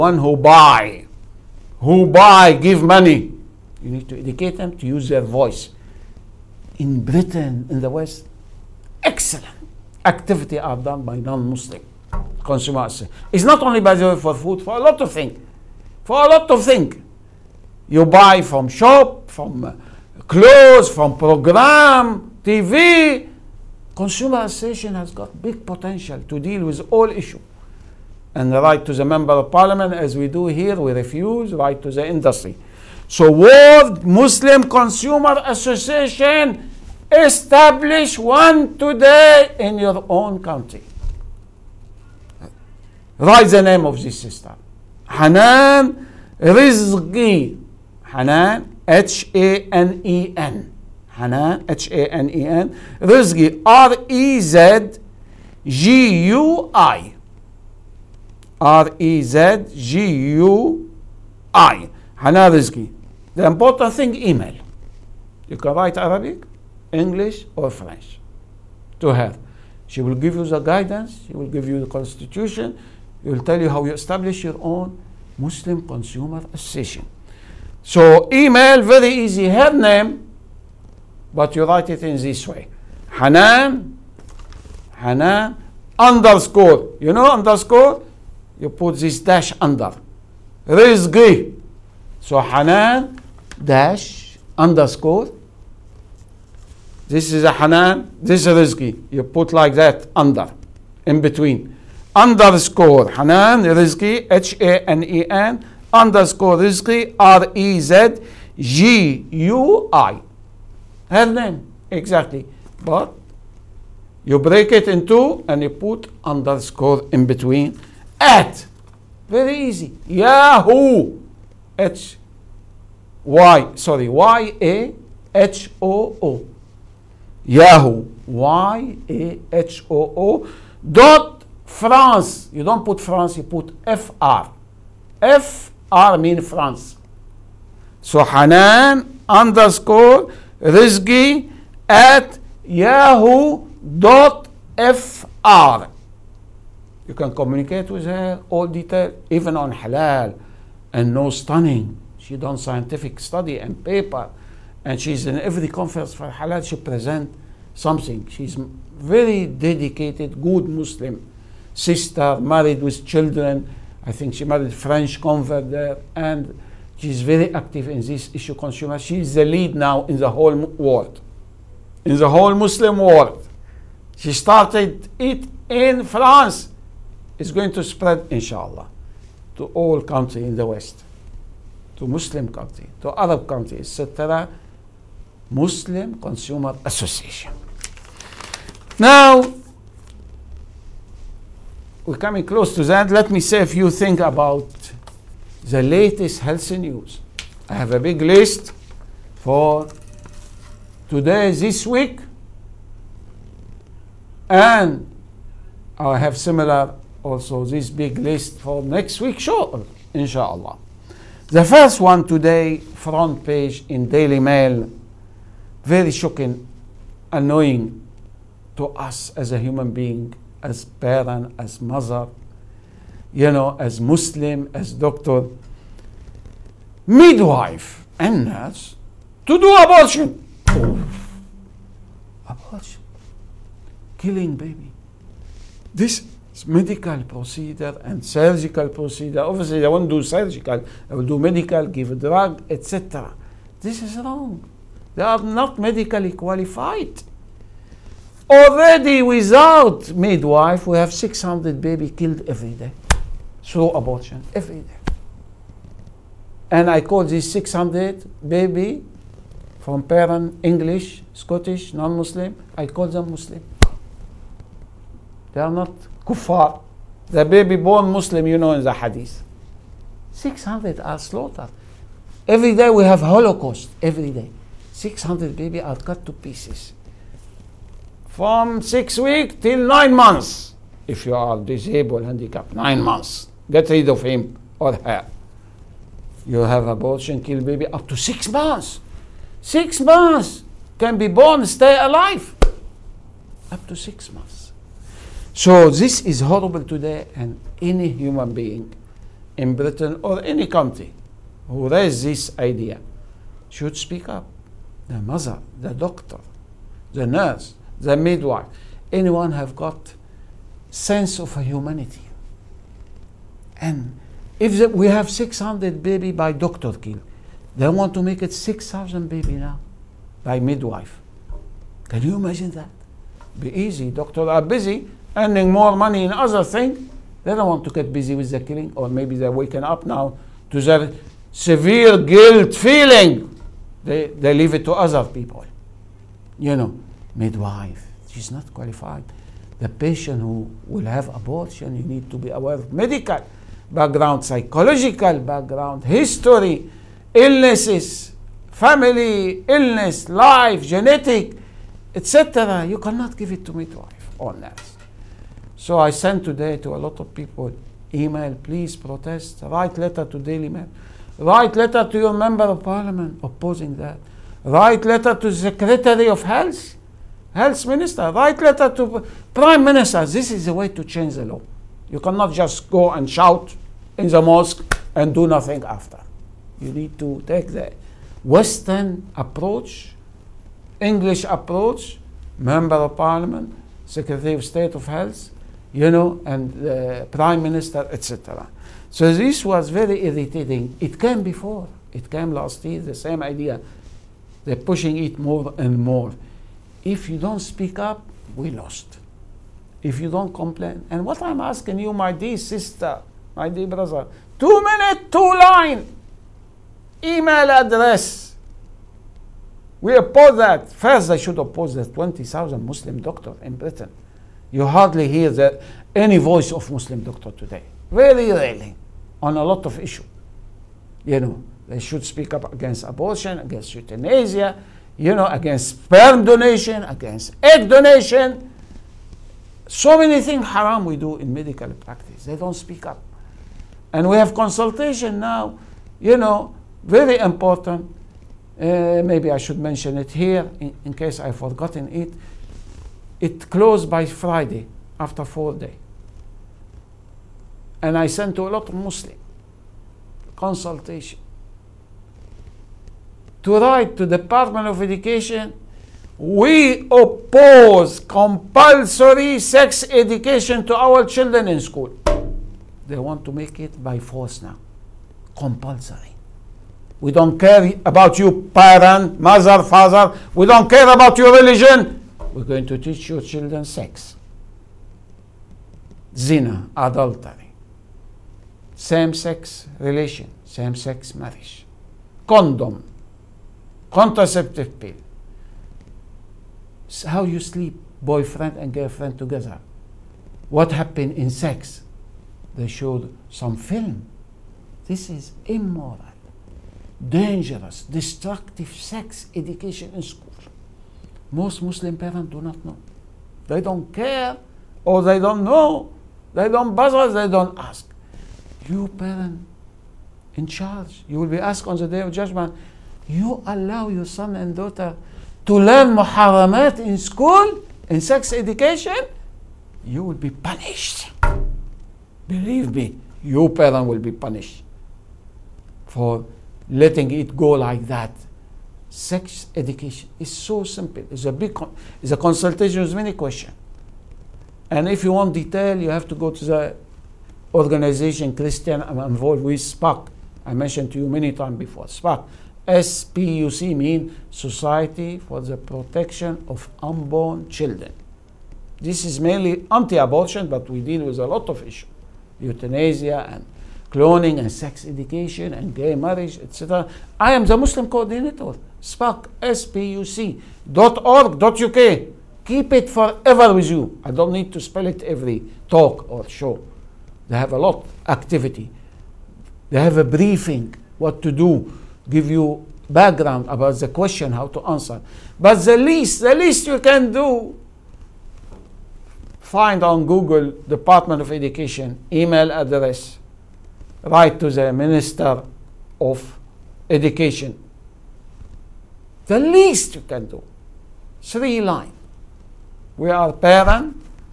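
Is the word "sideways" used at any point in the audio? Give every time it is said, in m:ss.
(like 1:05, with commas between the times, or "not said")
not said.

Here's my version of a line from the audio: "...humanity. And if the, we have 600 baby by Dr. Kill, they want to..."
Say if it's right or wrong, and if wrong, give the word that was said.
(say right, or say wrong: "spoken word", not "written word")
right.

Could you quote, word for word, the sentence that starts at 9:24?
I don't need to spell it every talk or show.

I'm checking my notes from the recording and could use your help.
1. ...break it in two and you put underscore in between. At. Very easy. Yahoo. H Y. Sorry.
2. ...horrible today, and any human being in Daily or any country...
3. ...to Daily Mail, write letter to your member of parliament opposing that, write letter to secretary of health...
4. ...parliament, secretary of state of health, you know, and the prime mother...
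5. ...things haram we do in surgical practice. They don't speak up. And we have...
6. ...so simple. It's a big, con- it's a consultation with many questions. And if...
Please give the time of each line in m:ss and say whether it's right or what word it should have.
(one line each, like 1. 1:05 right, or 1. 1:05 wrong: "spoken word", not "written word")
1. 1:54 right
2. 4:56 wrong: "Britain", not "Daily"
3. 6:00 right
4. 6:23 wrong: "minister", not "mother"
5. 7:10 wrong: "medical", not "surgical"
6. 8:50 right.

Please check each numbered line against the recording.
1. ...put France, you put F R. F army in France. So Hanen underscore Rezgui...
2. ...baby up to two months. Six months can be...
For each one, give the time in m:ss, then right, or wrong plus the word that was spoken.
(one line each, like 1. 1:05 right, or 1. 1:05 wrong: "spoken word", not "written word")
1. 2:12 right
2. 4:47 wrong: "six", not "two".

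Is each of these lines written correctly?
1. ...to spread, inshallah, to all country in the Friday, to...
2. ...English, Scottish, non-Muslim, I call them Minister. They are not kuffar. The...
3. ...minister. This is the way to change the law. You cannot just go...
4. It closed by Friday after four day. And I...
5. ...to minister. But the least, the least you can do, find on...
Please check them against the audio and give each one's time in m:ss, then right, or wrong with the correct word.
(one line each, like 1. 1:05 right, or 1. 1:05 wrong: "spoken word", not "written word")
1. 2:57 wrong: "West", not "Friday"
2. 4:20 wrong: "Muslim", not "Minister"
3. 6:09 right
4. 7:23 right
5. 9:34 wrong: "answer", not "minister".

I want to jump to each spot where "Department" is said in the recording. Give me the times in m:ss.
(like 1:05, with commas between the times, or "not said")
7:34, 9:40.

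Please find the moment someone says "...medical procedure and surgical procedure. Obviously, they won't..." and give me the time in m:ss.
3:56.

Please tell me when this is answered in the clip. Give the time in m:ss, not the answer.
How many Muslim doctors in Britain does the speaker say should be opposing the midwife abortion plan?
6:52.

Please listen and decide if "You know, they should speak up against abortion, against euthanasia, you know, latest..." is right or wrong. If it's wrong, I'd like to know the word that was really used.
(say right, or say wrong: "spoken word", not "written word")
wrong: "against", not "latest".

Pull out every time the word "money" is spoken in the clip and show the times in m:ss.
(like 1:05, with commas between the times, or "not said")
0:02, 5:25.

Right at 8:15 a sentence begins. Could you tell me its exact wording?
This is immoral, dangerous, destructive sex education in school.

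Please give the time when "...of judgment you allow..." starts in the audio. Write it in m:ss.
8:32.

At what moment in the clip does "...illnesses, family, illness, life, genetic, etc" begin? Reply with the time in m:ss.
5:47.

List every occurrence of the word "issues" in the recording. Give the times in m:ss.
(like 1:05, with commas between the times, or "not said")
0:27, 2:48, 6:59, 9:11.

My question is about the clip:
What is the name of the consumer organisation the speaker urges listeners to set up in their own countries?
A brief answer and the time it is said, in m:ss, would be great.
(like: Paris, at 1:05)
World Muslim Consumer Association, at 0:33.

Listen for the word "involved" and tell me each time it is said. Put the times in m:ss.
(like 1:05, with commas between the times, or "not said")
8:59.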